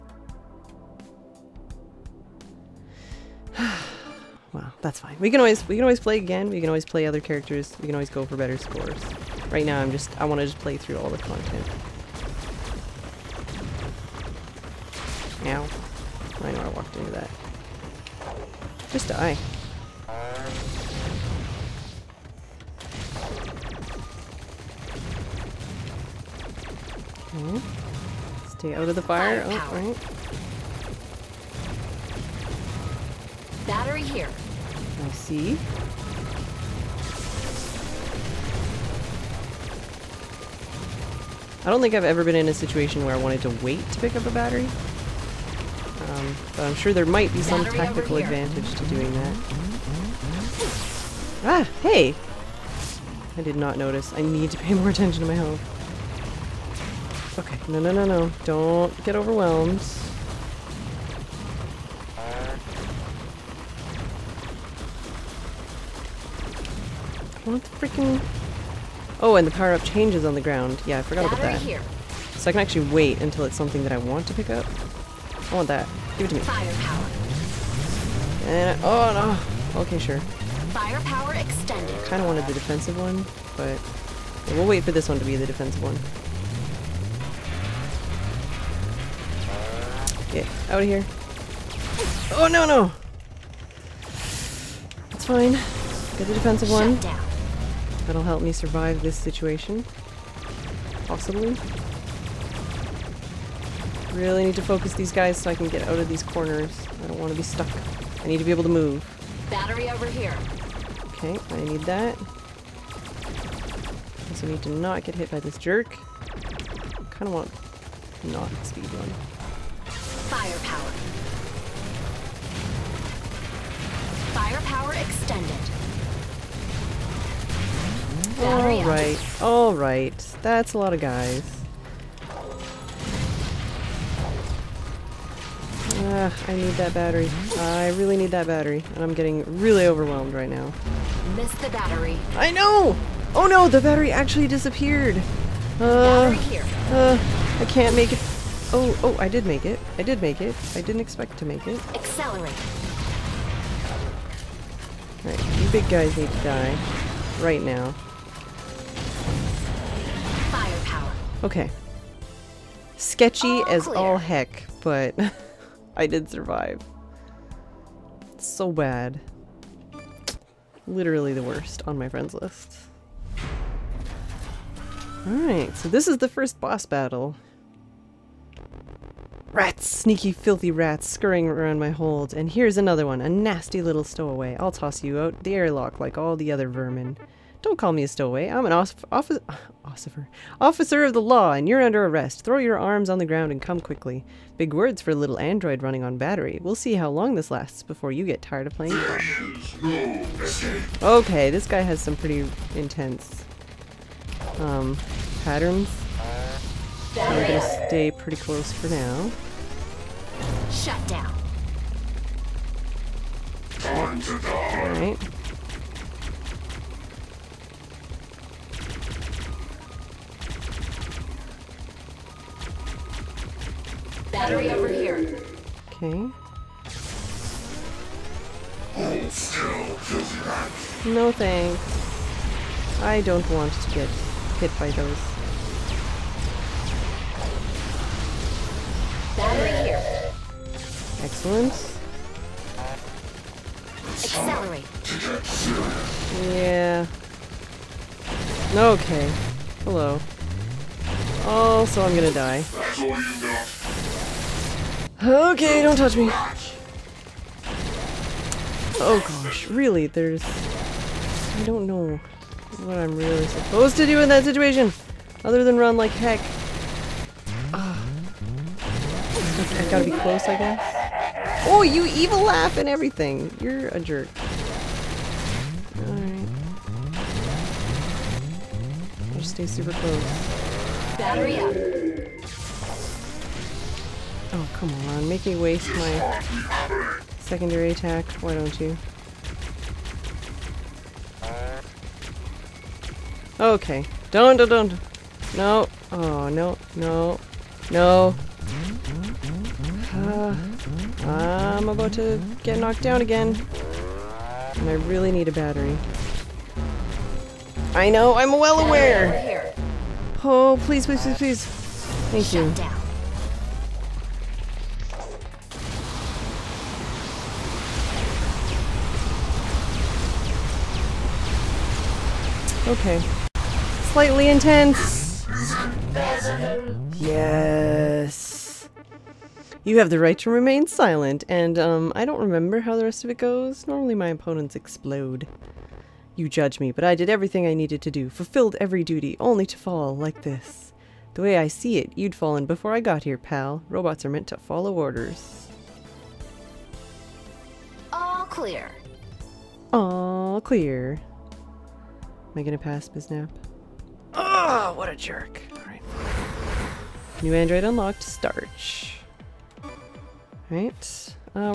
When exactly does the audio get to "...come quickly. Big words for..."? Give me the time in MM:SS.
03:13.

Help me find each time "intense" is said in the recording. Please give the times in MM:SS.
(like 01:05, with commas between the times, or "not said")
03:22, 05:24.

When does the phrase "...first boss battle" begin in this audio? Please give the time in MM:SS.
02:56.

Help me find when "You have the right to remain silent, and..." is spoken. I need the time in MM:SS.
05:29.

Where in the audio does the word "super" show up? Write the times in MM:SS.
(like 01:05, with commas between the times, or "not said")
04:39.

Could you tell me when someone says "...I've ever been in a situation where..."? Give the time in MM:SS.
00:41.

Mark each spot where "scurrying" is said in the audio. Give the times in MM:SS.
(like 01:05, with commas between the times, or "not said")
03:01.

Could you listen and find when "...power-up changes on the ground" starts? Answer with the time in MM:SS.
01:09.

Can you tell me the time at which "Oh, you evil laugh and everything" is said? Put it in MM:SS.
04:31.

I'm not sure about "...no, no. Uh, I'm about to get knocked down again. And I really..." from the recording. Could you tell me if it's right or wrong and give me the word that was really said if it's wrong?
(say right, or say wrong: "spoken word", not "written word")
right.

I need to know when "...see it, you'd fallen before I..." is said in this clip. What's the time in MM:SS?
05:41.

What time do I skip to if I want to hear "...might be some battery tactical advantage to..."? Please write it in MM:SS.
00:47.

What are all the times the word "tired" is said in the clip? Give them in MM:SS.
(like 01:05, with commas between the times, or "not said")
03:18.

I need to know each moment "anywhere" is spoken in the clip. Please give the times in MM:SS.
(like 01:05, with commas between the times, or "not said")
not said.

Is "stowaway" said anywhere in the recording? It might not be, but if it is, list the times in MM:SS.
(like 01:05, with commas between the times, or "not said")
03:04, 03:08.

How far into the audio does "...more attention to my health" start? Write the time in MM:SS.
00:54.